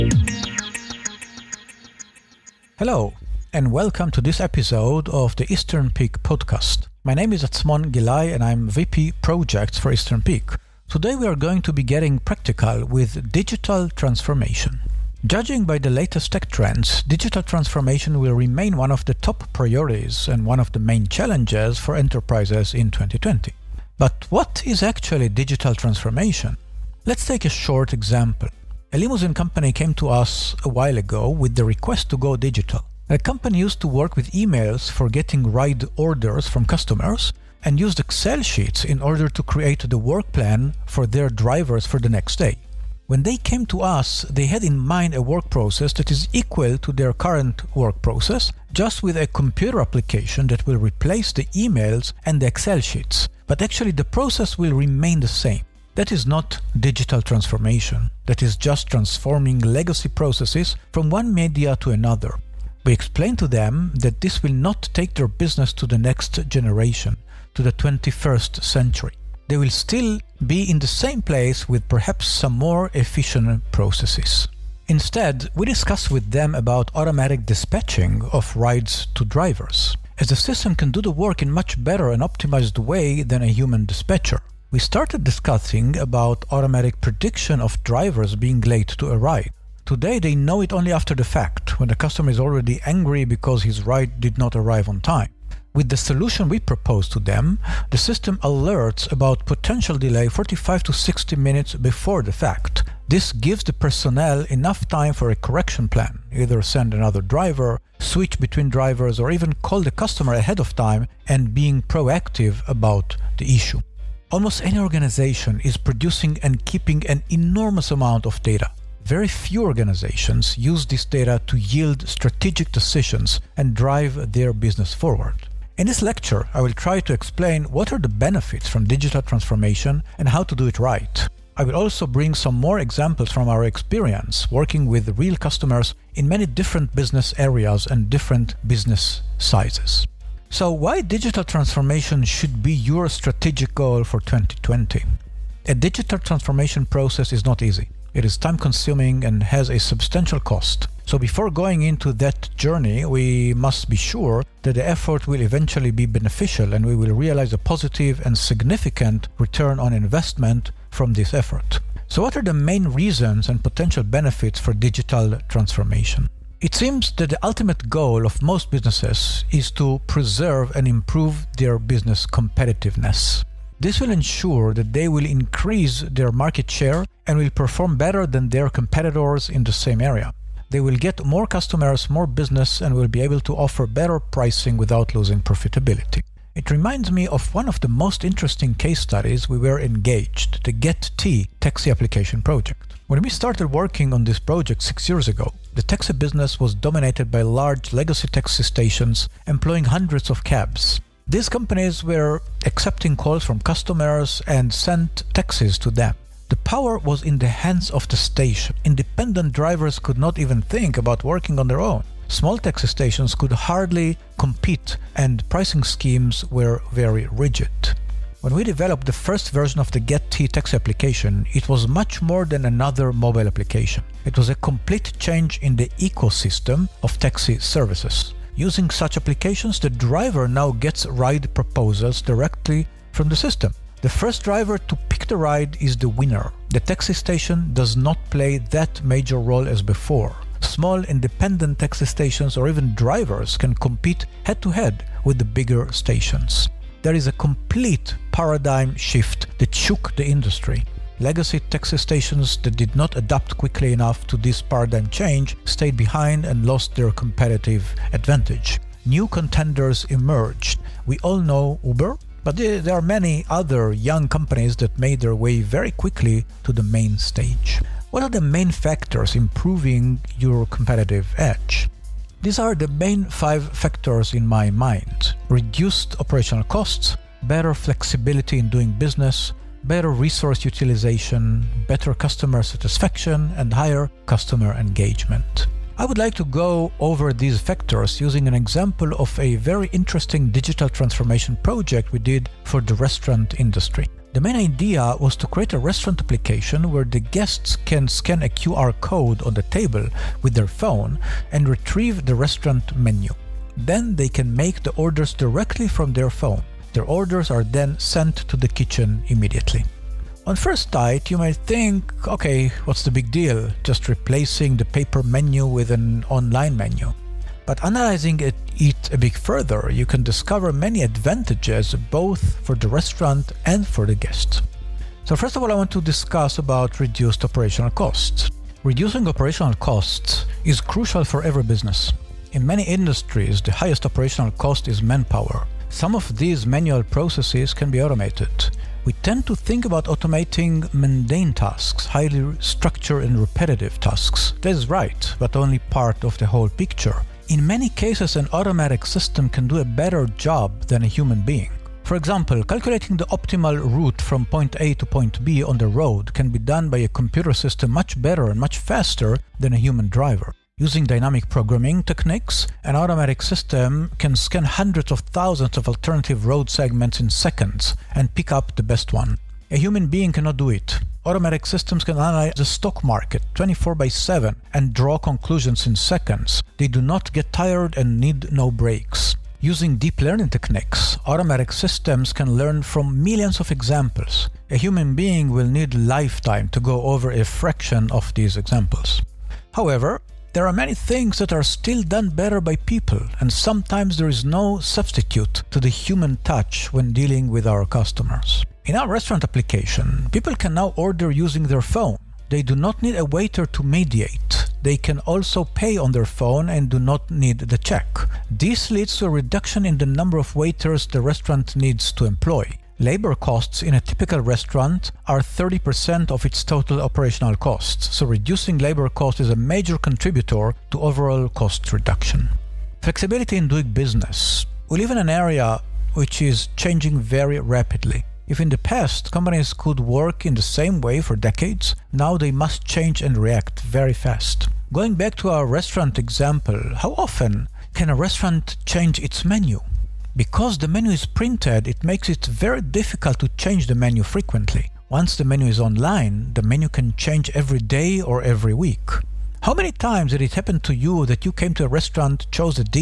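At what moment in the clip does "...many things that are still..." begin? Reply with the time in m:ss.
6:30.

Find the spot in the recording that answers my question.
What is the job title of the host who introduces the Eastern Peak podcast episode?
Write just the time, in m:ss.
0:08.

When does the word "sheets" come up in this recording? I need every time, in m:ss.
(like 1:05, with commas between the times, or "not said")
0:38, 0:52.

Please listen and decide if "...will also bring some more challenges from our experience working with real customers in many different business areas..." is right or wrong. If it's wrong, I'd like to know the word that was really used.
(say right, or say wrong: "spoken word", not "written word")
wrong: "examples", not "challenges".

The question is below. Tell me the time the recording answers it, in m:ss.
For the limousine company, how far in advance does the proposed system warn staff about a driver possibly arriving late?
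1:40.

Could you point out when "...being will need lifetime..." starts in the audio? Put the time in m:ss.
6:25.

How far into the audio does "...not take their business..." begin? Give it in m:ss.
1:04.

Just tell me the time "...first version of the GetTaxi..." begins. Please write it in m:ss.
3:39.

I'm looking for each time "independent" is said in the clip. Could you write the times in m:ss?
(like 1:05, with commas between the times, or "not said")
3:28, 4:01.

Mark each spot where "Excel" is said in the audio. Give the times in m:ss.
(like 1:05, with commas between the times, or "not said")
0:37, 0:52.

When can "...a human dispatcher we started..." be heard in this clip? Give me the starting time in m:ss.
1:23.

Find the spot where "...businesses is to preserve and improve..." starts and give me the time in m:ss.
2:48.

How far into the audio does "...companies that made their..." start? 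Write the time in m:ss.
4:24.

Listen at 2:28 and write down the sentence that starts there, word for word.
It is time consuming and has a substantial cost.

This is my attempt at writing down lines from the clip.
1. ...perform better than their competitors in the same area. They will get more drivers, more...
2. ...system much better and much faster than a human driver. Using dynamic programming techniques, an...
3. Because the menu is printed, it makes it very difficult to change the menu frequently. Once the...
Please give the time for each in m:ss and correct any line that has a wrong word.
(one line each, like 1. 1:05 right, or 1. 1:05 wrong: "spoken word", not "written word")
1. 2:57 wrong: "customers", not "drivers"
2. 5:57 right
3. 7:20 right.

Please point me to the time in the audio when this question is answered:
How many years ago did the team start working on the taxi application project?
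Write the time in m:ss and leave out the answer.
3:14.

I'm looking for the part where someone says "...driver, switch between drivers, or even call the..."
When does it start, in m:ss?
1:47.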